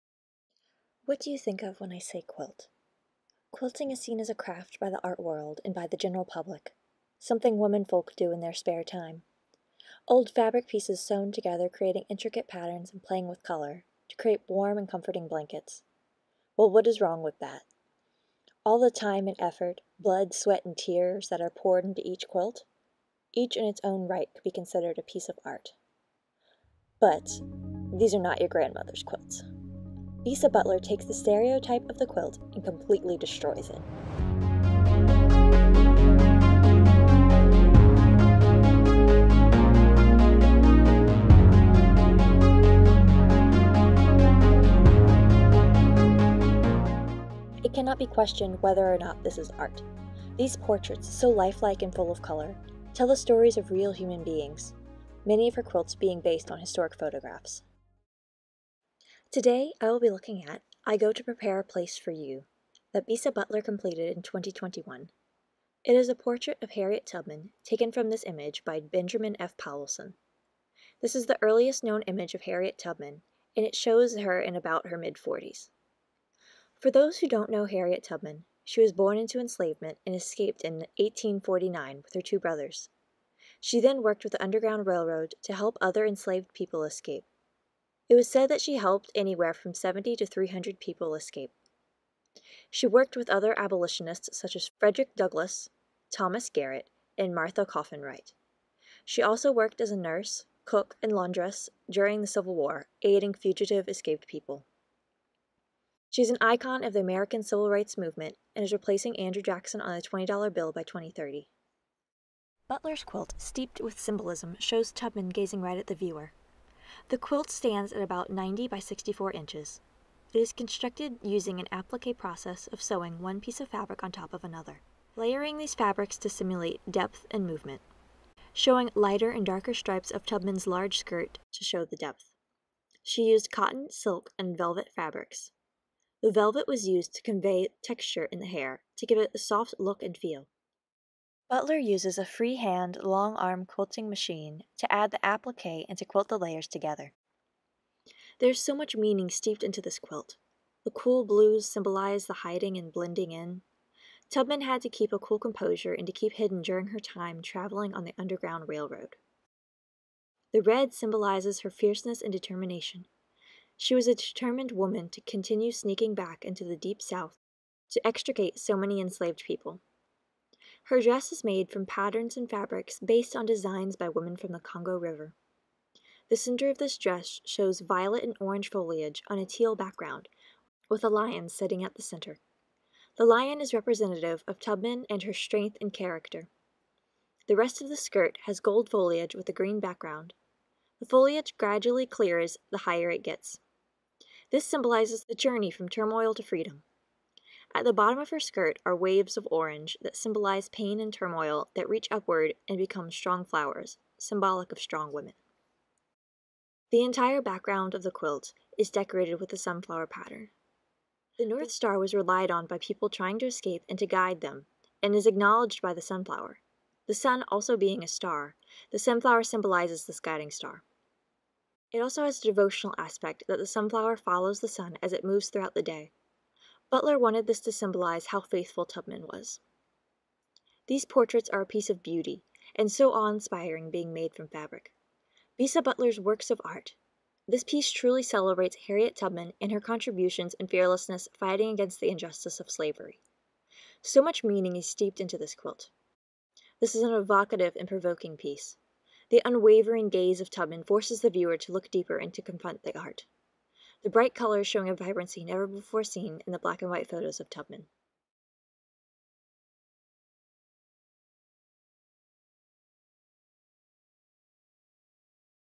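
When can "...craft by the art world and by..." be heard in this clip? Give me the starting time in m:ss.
0:04.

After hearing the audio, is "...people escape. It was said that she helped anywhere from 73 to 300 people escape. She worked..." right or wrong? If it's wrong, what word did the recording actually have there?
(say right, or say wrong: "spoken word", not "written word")
wrong: "70", not "73".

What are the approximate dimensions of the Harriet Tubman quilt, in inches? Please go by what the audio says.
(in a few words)
90 by 64 inches.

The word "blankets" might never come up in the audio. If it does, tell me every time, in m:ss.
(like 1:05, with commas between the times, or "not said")
0:15.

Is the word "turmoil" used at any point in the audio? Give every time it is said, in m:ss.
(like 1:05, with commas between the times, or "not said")
3:15, 3:21.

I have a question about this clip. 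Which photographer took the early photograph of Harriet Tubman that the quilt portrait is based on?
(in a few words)
Benjamin F. Powelson.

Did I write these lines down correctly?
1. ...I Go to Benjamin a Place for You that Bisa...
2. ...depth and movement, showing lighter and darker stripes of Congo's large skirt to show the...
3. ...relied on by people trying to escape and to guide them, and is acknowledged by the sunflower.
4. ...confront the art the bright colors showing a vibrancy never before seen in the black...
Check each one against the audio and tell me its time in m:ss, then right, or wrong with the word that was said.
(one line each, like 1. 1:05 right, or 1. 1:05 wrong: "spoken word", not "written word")
1. 1:00 wrong: "Prepare", not "Benjamin"
2. 2:06 wrong: "Tubman", not "Congo"
3. 3:32 right
4. 4:12 right.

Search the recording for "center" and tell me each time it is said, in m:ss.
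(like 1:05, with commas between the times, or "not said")
2:56, 3:02.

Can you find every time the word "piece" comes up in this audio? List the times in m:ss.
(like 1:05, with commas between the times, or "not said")
0:10, 0:25, 2:03, 3:51, 3:57, 4:08.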